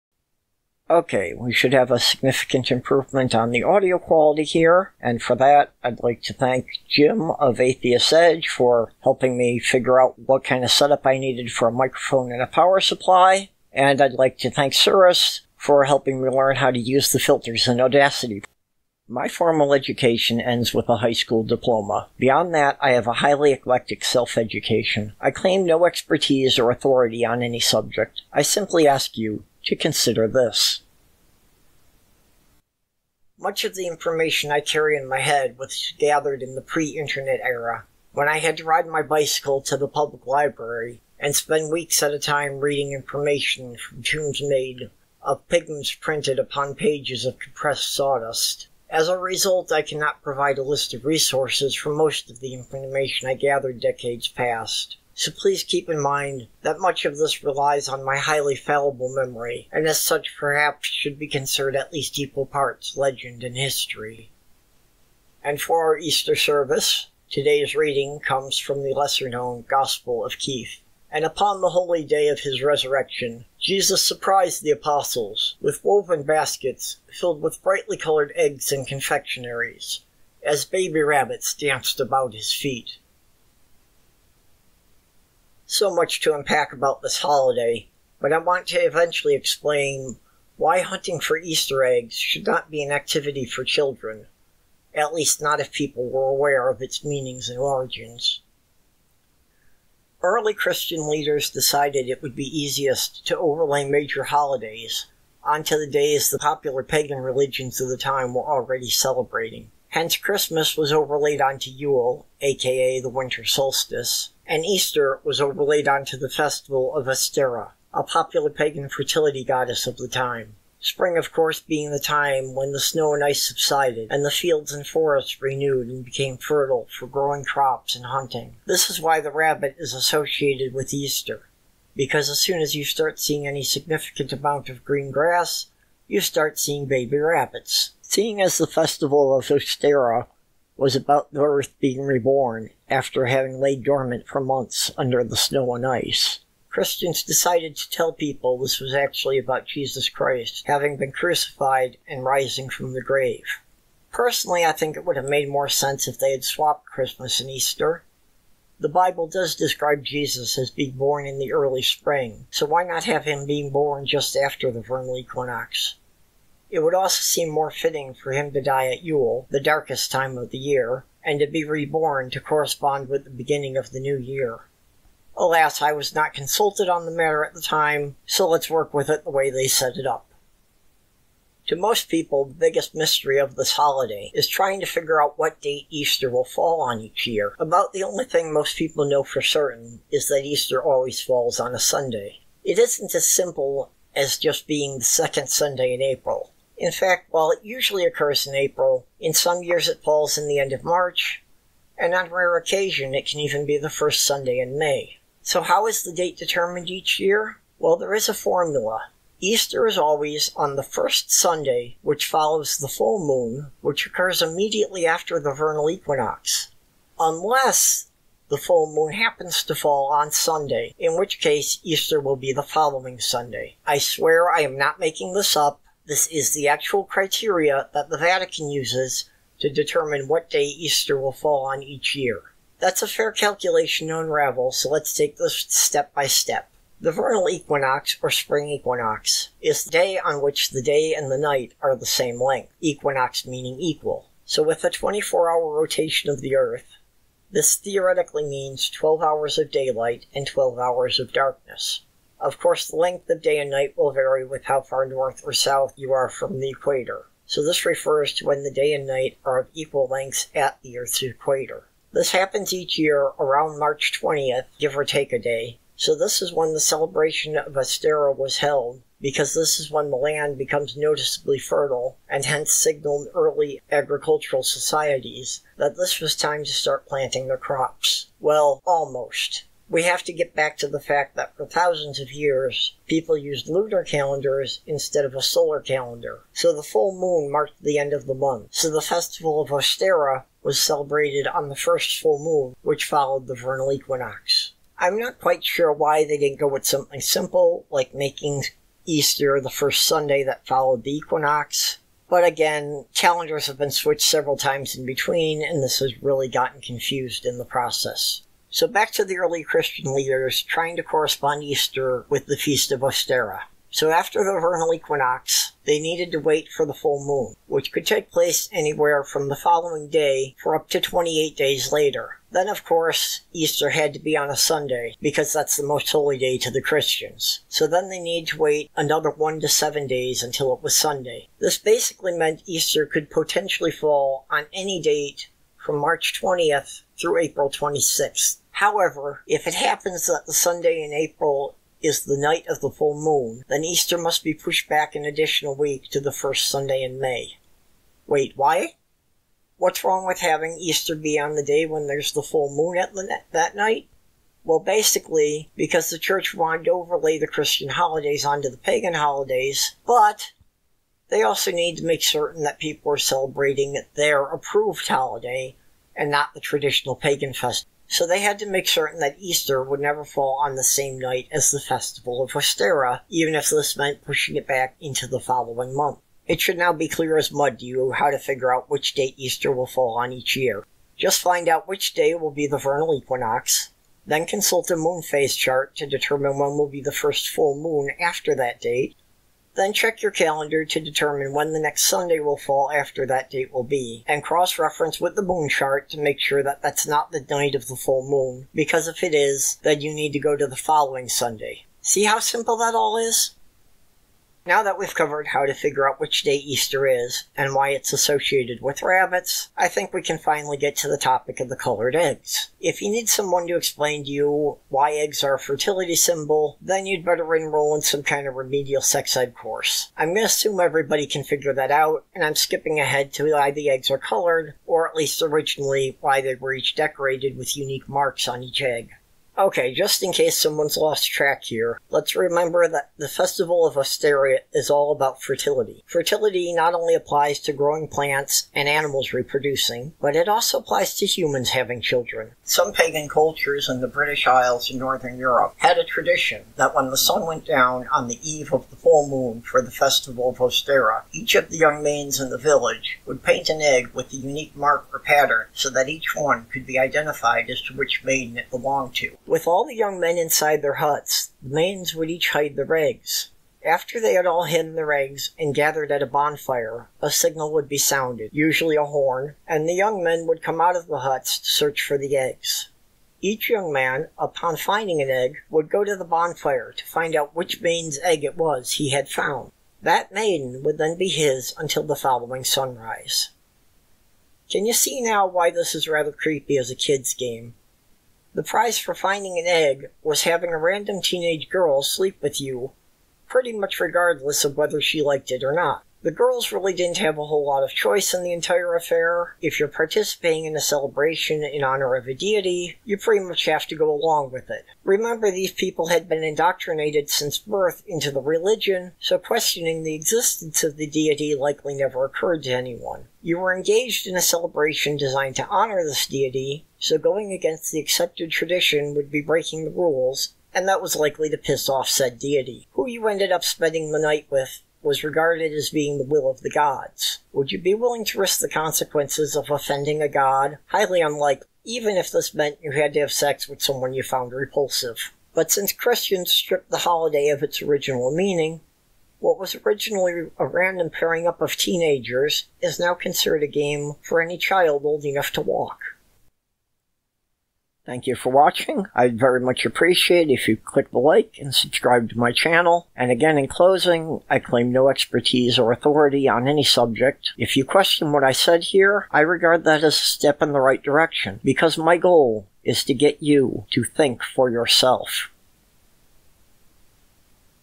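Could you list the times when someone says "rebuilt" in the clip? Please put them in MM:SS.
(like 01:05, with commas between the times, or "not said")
not said.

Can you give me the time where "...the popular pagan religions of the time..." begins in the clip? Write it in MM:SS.
01:46.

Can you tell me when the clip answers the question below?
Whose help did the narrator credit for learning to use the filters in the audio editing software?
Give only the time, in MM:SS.
00:14.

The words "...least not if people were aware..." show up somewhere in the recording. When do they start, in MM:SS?
01:35.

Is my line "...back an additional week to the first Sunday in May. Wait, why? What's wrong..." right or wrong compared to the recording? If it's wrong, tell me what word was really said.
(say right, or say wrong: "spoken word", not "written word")
right.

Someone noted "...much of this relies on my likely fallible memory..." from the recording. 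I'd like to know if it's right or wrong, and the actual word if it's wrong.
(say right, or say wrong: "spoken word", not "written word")
wrong: "highly", not "likely".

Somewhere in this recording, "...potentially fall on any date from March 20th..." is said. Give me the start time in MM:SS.
05:33.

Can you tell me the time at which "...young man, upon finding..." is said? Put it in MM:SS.
07:53.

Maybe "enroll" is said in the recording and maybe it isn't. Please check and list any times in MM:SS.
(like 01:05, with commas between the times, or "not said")
06:57.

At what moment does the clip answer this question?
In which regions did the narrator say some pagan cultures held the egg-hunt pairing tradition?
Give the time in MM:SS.
07:24.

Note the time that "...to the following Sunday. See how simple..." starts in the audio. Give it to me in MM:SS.
06:40.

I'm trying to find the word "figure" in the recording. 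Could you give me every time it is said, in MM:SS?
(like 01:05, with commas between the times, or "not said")
00:09, 03:04, 06:18, 06:45, 07:01.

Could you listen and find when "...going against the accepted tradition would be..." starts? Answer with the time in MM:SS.
08:37.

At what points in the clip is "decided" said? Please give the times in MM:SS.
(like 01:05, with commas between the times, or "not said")
01:41, 02:27.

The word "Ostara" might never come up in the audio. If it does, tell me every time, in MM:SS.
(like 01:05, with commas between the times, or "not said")
01:57, 02:19, 04:27, 04:49, 05:13, 06:12, 07:30.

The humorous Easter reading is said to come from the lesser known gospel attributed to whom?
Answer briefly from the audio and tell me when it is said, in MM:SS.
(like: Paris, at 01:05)
Keith, at 01:10.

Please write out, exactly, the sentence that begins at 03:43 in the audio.
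I swear I am not making this up.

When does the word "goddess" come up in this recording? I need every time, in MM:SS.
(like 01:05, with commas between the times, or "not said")
01:59.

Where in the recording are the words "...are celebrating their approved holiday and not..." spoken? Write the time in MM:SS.
06:03.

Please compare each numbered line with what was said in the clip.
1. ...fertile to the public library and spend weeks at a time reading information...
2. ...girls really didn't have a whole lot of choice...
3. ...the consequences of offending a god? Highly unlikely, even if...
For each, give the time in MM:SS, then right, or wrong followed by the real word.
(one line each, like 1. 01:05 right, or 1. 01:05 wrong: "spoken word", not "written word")
1. 00:39 wrong: "bicycle", not "fertile"
2. 08:16 right
3. 08:48 right.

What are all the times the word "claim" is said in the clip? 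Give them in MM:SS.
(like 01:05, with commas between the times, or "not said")
00:25, 09:14.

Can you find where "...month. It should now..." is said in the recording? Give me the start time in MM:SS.
06:15.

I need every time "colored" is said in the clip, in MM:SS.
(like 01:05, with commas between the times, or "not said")
01:17, 06:51, 07:04.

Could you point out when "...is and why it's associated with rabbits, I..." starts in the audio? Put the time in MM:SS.
06:47.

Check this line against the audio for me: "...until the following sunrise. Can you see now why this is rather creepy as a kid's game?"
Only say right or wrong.
right.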